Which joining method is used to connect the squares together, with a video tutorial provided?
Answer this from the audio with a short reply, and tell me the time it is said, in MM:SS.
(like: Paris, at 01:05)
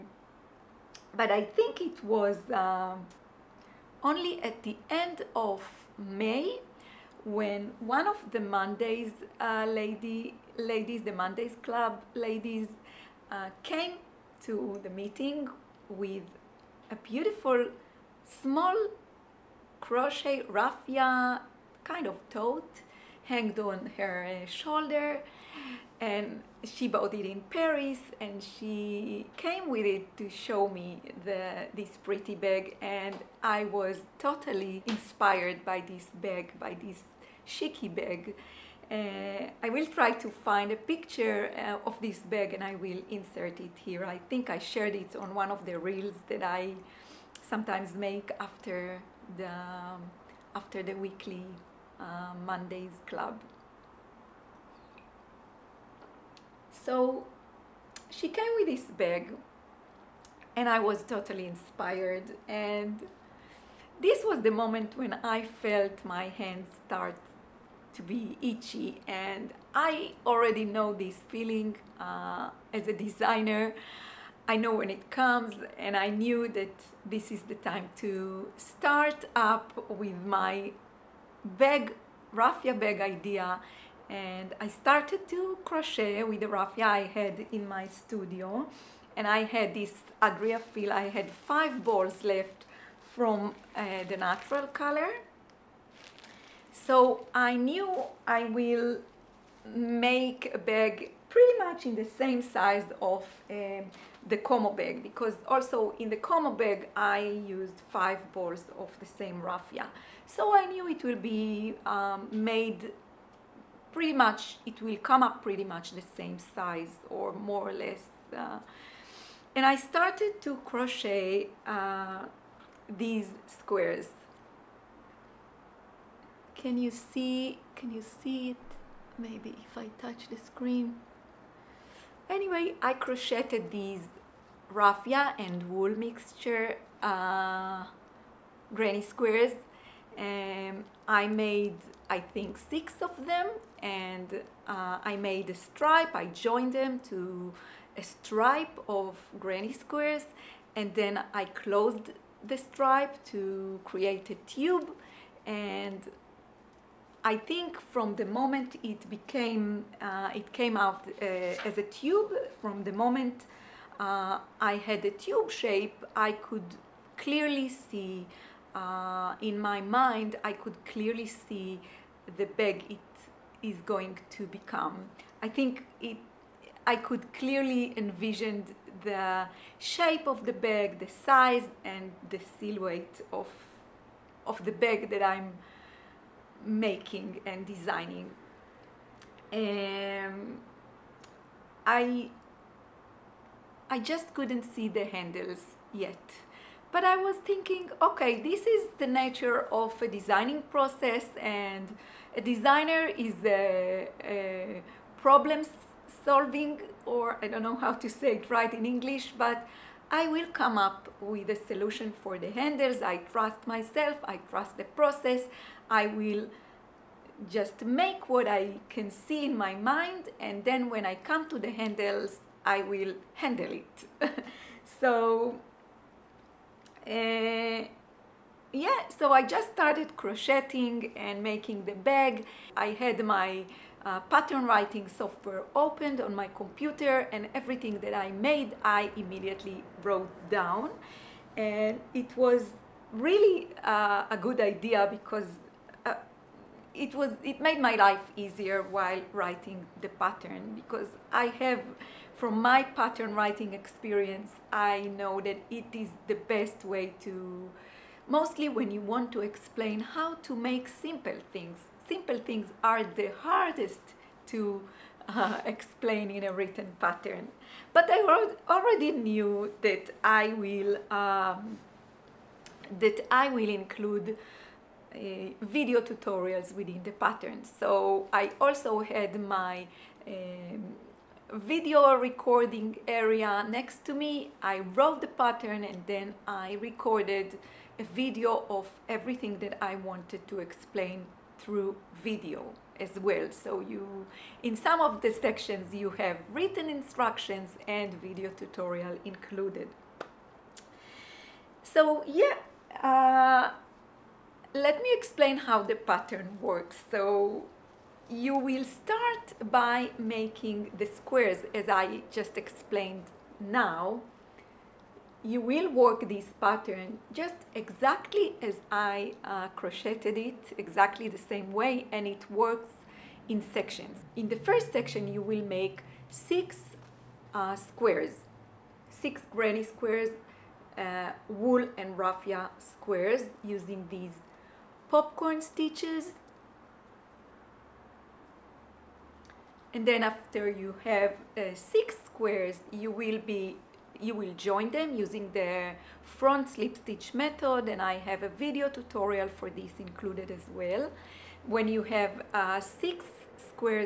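front slip stitch, at 05:46.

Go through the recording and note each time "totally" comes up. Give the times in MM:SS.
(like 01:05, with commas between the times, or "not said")
00:34, 01:01.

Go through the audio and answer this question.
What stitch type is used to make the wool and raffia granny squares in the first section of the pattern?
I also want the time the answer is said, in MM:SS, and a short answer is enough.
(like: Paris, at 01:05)
popcorn stitches, at 05:35.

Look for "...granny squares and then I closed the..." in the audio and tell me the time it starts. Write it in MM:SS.
02:29.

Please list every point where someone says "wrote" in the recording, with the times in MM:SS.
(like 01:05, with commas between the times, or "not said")
04:00, 04:44.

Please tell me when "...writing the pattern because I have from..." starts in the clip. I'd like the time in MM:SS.
04:09.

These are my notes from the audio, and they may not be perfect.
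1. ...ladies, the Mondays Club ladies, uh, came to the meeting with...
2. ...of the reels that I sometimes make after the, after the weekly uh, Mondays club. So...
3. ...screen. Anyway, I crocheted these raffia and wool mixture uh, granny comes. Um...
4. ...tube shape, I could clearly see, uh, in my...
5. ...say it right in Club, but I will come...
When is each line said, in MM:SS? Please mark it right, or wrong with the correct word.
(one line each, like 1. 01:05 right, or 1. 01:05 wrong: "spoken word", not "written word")
1. 00:10 right
2. 00:45 right
3. 02:10 wrong: "squares", not "comes"
4. 02:45 right
5. 03:28 wrong: "English", not "Club".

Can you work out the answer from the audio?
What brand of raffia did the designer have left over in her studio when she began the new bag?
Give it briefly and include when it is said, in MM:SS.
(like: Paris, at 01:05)
Adriafil, at 01:30.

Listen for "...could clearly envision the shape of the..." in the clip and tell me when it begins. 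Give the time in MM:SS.
02:56.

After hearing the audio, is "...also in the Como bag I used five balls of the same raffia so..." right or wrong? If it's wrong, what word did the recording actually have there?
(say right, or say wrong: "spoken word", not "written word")
right.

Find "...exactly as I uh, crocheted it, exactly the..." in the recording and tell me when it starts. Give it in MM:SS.
05:17.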